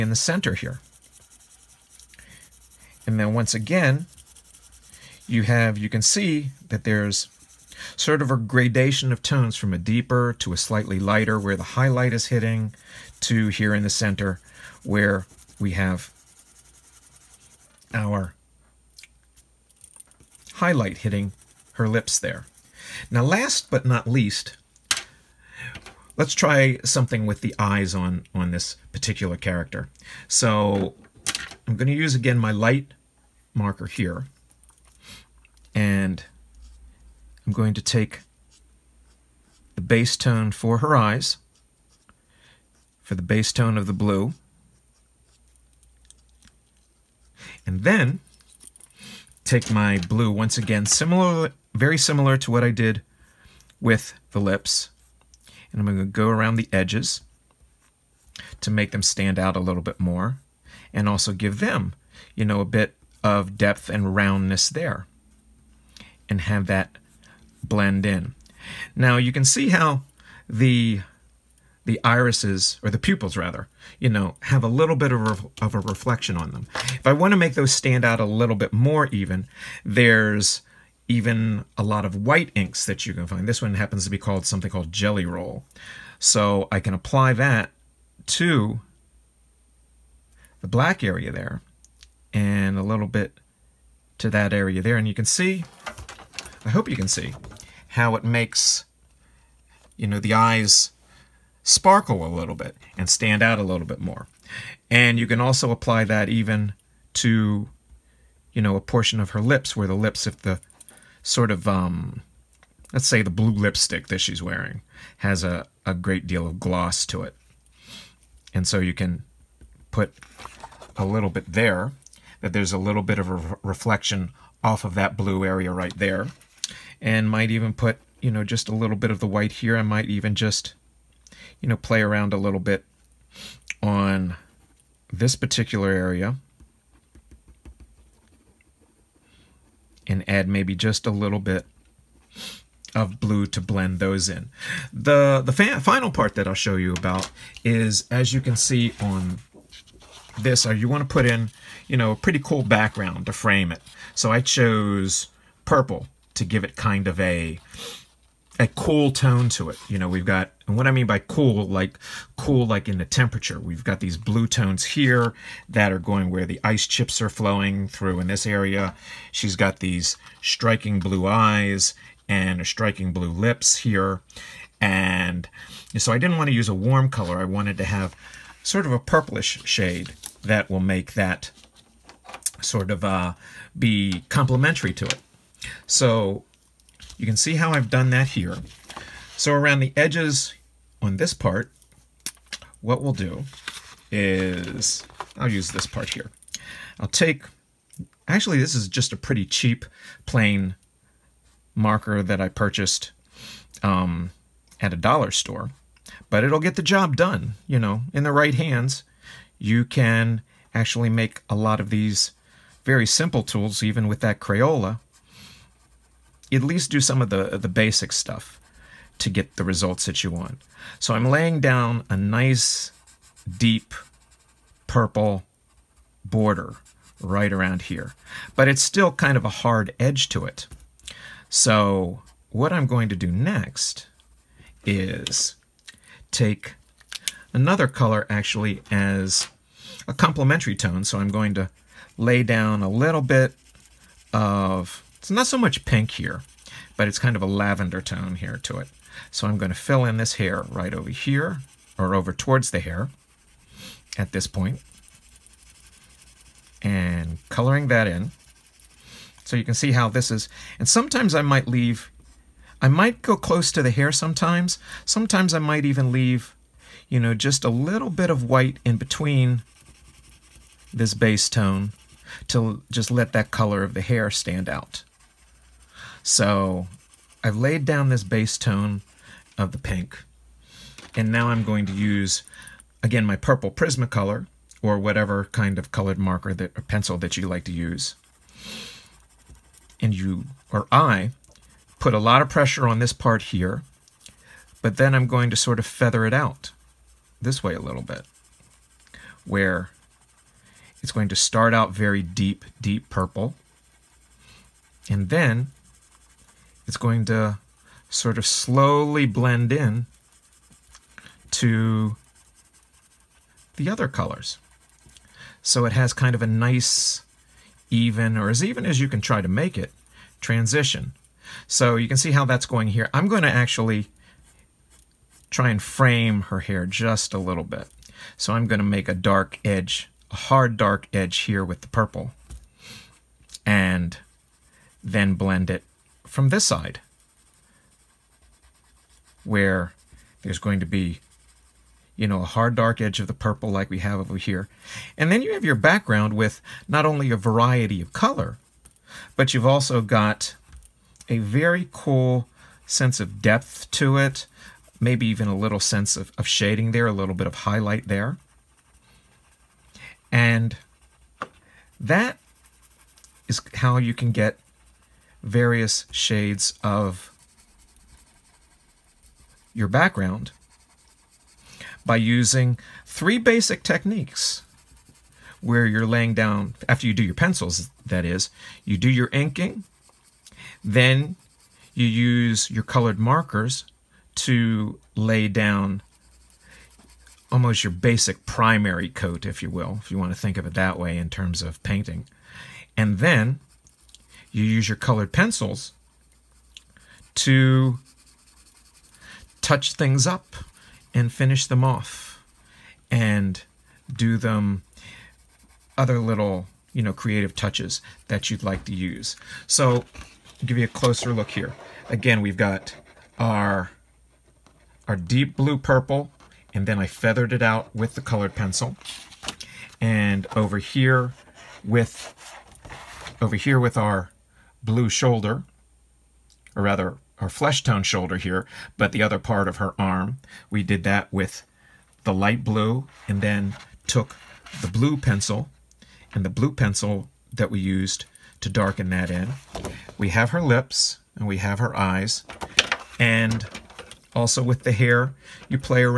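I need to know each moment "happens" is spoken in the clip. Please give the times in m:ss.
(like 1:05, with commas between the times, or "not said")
1:23.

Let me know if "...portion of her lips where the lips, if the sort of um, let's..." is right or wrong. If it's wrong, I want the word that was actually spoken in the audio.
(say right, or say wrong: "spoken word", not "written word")
right.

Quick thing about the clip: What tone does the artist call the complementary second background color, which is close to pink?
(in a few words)
Lavender.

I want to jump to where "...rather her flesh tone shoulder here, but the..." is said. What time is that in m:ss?
7:06.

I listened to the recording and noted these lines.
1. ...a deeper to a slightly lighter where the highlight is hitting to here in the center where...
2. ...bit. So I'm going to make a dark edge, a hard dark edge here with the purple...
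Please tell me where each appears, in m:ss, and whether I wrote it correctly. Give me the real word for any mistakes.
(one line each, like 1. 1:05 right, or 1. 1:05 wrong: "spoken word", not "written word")
1. 0:09 right
2. 5:27 right.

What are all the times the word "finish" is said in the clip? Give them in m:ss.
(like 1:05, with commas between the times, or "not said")
6:41.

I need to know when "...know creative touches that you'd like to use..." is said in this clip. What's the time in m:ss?
6:47.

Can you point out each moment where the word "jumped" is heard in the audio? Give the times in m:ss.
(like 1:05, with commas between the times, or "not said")
not said.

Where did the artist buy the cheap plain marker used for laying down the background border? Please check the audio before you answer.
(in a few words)
A dollar store.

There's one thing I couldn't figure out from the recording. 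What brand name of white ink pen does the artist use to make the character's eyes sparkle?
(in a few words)
Gelly Roll.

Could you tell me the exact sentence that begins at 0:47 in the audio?
And then take my blue once again, similar, very similar to what I did with the lips.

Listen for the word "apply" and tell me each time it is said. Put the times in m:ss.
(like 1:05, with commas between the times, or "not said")
1:26, 1:45.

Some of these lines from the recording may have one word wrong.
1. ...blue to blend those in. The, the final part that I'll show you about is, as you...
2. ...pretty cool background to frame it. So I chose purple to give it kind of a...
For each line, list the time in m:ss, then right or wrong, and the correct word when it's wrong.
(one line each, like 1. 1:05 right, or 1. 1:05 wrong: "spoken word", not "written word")
1. 2:23 right
2. 2:32 right.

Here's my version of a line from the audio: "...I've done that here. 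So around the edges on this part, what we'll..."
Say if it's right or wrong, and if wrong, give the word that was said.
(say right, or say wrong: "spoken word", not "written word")
right.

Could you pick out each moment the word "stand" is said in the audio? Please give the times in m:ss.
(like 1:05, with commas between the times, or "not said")
0:59, 1:17, 1:43, 4:34.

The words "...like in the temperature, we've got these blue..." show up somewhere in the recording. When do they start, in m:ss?
2:42.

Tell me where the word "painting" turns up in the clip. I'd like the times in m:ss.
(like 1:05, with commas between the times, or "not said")
6:31.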